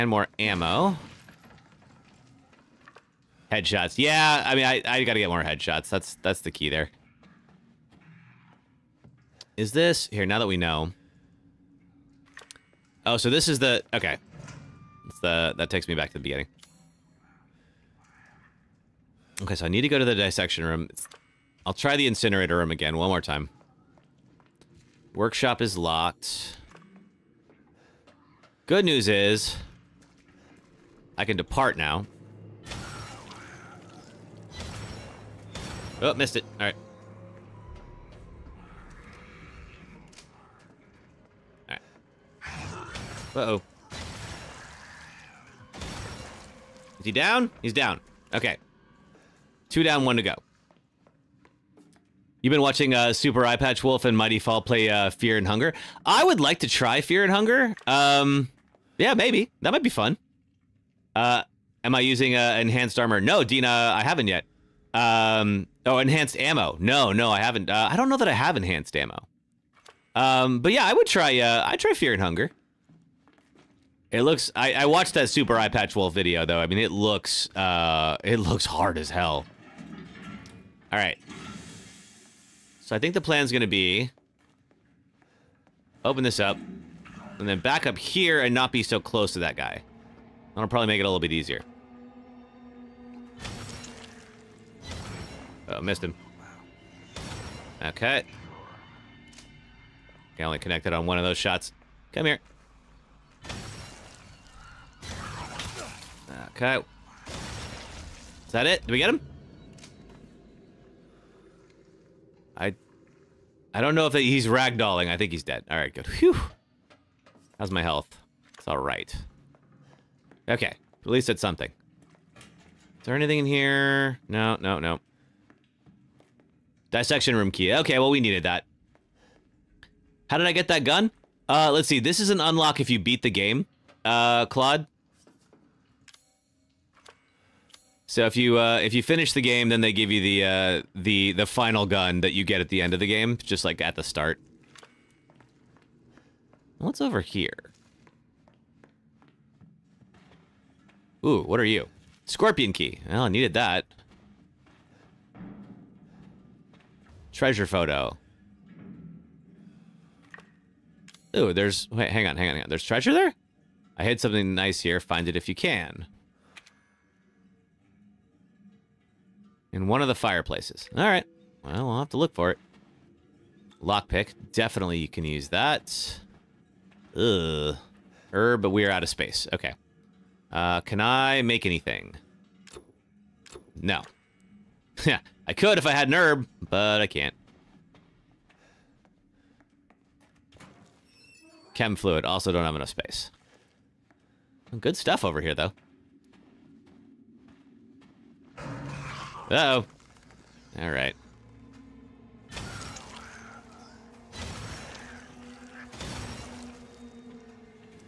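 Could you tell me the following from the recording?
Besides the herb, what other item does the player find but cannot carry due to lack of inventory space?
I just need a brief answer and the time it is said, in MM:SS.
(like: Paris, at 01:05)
Chem fluid, at 03:11.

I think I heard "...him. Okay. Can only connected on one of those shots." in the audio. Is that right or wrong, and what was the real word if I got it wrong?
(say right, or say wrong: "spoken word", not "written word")
right.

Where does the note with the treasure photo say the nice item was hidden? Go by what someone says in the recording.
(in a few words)
in one of the fireplaces.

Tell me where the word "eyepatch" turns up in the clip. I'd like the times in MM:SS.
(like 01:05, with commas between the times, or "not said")
00:53, 01:15.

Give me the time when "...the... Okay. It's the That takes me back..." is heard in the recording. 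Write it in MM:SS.
00:13.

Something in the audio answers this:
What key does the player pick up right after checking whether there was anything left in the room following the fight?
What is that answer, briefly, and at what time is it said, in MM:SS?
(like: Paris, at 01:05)
Dissection room key, at 02:06.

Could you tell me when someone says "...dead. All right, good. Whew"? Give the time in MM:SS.
01:55.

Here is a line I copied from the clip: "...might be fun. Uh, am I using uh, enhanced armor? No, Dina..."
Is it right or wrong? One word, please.
right.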